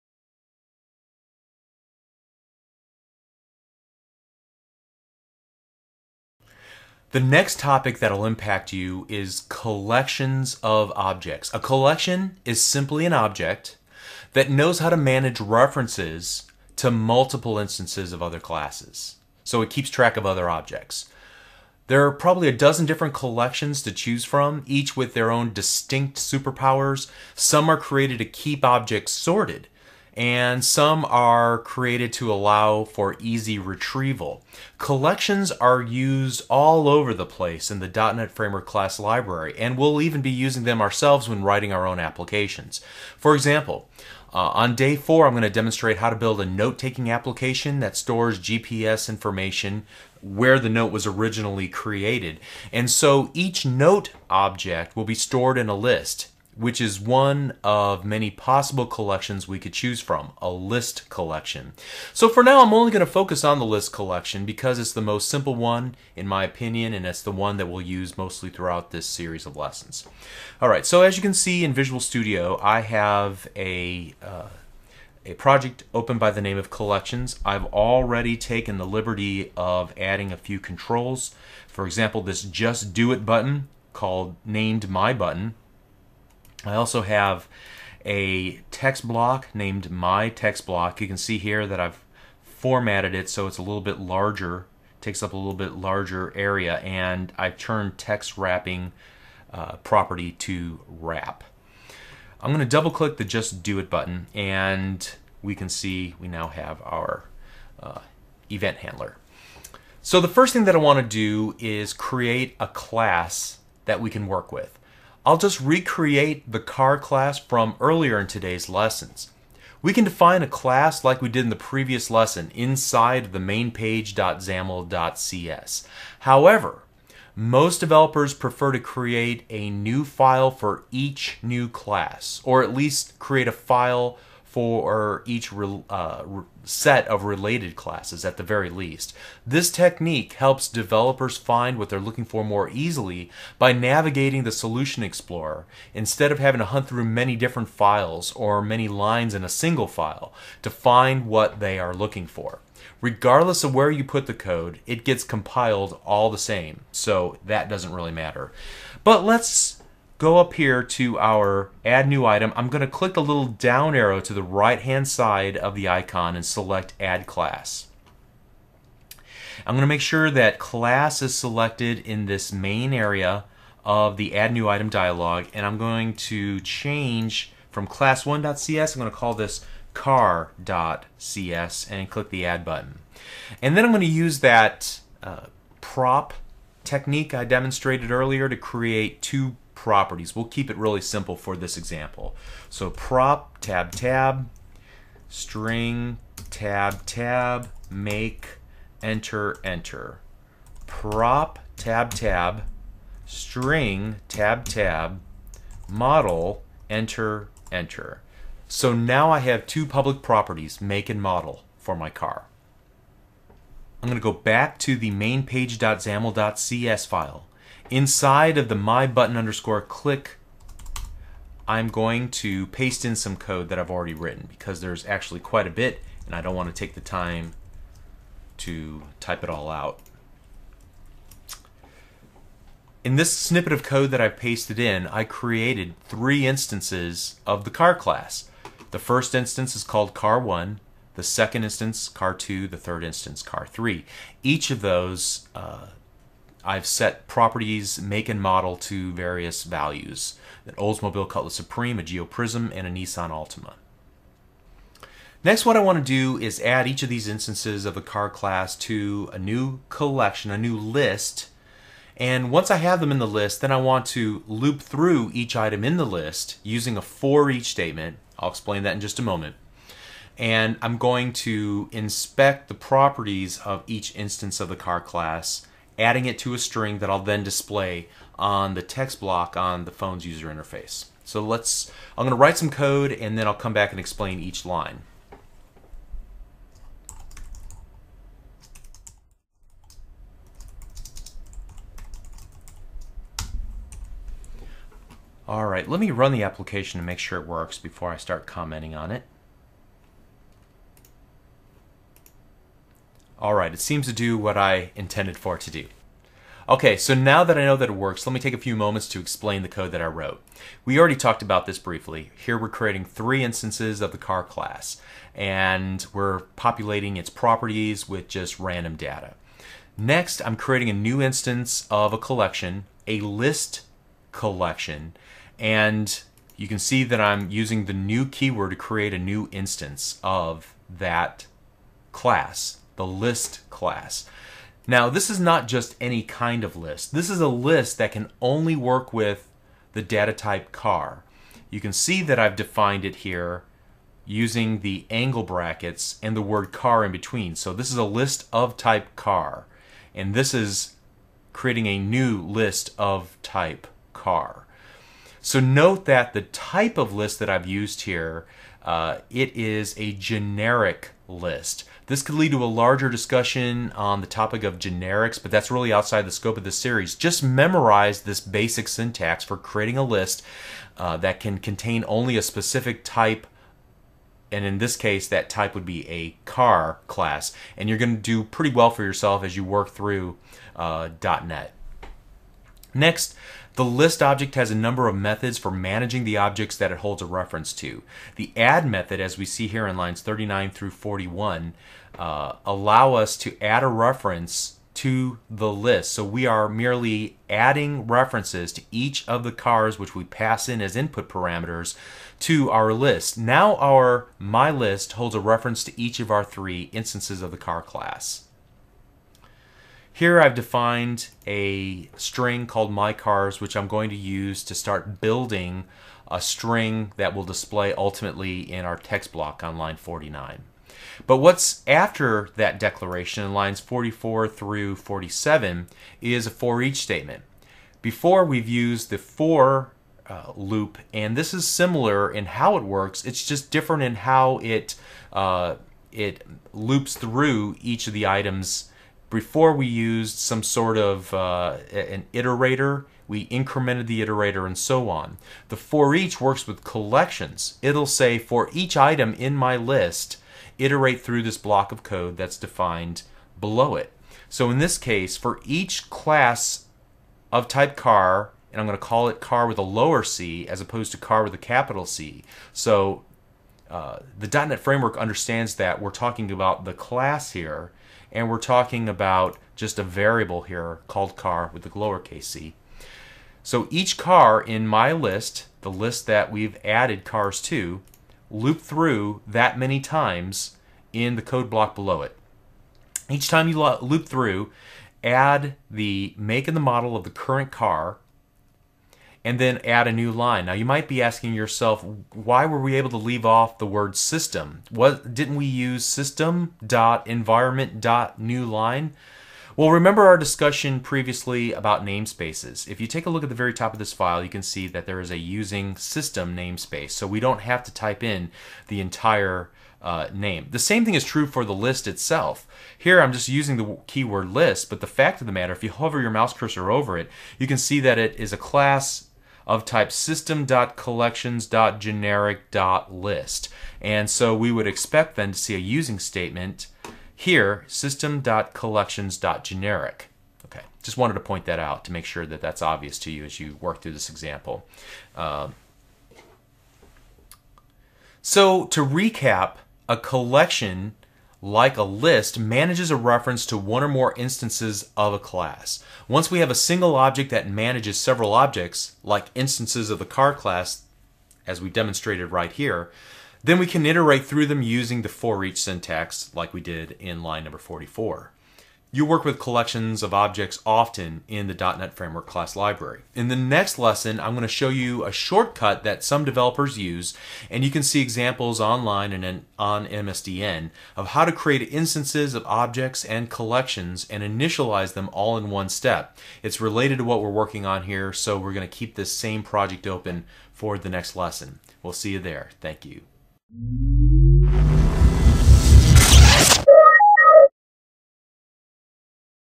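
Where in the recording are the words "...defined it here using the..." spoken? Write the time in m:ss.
5:42.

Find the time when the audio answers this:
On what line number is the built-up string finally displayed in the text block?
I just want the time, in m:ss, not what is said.
6:59.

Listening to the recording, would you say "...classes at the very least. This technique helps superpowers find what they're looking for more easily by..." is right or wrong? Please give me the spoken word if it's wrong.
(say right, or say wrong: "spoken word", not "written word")
wrong: "developers", not "superpowers".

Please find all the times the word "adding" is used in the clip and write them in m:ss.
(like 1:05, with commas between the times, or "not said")
1:19, 4:35, 6:37.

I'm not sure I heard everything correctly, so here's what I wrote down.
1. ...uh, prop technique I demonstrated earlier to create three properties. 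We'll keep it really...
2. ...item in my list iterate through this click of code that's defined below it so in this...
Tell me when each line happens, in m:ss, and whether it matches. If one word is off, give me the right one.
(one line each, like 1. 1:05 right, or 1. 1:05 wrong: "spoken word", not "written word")
1. 3:05 wrong: "two", not "three"
2. 7:28 wrong: "block", not "click".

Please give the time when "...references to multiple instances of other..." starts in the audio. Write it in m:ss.
0:15.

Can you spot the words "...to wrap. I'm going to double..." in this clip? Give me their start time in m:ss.
1:40.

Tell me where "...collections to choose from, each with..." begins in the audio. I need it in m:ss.
0:23.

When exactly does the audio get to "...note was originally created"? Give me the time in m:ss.
0:50.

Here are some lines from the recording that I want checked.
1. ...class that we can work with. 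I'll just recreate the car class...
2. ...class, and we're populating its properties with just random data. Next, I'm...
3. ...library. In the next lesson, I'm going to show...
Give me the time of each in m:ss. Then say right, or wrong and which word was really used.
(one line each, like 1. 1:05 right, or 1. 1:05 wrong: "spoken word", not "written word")
1. 1:52 right
2. 5:14 right
3. 9:22 right.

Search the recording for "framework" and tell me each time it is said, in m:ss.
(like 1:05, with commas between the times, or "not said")
0:38, 7:44, 9:22.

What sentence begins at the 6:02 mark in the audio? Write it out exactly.
This could lead to a larger discussion on the topic of generics, but that's really outside the scope of this series.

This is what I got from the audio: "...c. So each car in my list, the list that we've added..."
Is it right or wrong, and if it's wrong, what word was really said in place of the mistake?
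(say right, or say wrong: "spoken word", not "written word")
right.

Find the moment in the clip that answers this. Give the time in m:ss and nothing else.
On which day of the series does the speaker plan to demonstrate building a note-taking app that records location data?
0:44.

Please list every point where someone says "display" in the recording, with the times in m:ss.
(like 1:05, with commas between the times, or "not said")
4:37, 6:57.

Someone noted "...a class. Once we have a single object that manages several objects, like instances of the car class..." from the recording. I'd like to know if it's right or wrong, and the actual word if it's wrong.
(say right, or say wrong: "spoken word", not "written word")
right.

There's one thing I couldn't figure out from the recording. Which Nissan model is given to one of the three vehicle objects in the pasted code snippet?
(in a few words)
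Altima.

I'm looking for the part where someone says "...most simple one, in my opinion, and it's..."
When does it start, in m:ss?
1:05.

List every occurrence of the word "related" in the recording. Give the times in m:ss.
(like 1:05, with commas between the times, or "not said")
2:17, 9:36.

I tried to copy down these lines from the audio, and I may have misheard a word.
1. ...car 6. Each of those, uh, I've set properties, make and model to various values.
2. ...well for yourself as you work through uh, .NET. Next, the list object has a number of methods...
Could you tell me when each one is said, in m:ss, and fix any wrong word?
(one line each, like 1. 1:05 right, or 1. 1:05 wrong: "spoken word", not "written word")
1. 4:03 wrong: "3", not "6"
2. 6:18 right.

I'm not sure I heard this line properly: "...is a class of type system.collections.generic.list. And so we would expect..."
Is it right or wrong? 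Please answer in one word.
right.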